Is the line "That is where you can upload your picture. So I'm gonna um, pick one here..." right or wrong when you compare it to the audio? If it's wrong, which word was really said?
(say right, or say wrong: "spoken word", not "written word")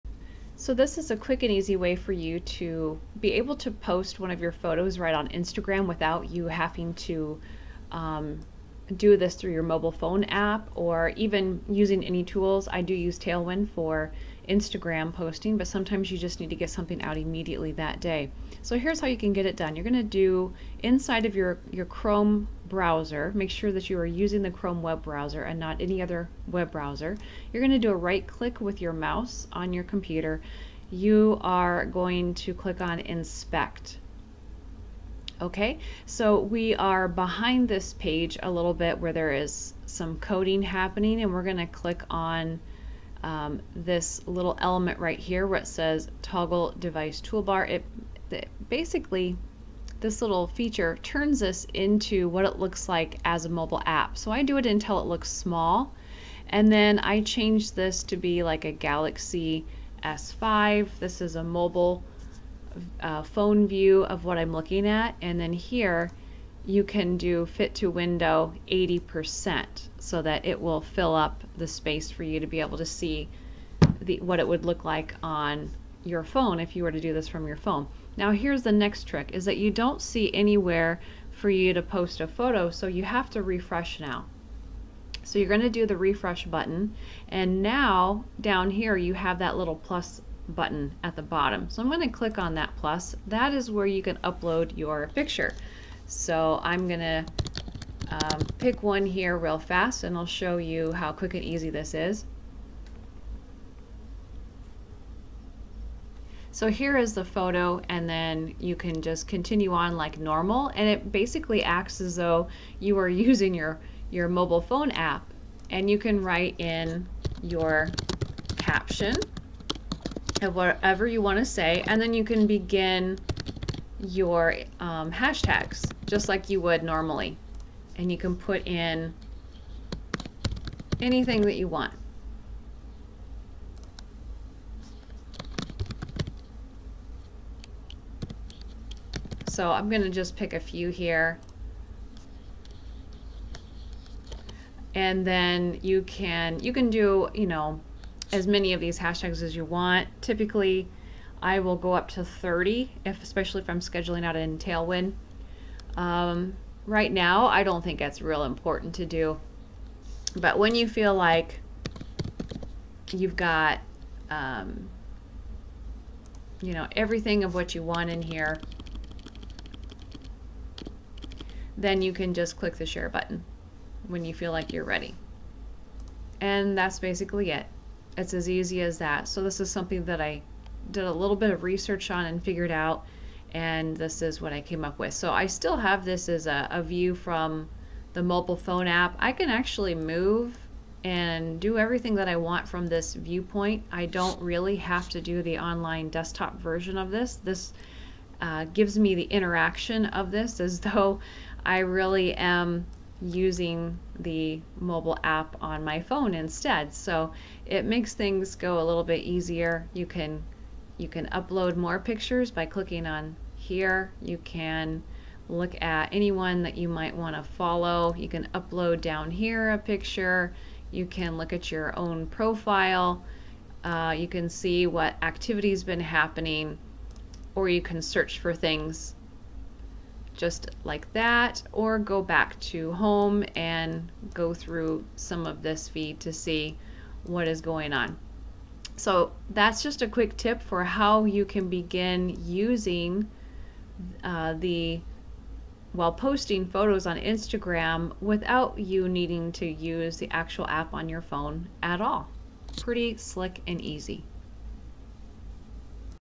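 right.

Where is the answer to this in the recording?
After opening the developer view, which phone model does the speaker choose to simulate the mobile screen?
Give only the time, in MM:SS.
00:58.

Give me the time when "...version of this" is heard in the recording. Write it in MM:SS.
03:16.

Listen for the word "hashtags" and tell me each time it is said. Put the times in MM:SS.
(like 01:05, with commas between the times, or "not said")
02:05, 02:28.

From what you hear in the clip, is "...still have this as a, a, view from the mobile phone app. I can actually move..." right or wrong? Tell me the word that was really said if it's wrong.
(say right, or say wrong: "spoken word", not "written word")
right.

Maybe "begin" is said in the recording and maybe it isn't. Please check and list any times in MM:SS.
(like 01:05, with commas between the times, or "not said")
02:02, 04:01.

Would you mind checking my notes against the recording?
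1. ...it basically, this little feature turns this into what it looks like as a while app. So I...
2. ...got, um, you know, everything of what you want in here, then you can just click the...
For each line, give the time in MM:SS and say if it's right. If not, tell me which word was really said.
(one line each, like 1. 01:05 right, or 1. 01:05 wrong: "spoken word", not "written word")
1. 00:48 wrong: "mobile", not "while"
2. 02:43 right.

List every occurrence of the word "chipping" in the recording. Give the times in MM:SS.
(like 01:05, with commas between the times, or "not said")
not said.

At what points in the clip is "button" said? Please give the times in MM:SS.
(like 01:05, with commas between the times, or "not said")
01:26, 01:30, 02:53.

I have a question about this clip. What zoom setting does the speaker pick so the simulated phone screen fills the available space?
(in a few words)
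80%.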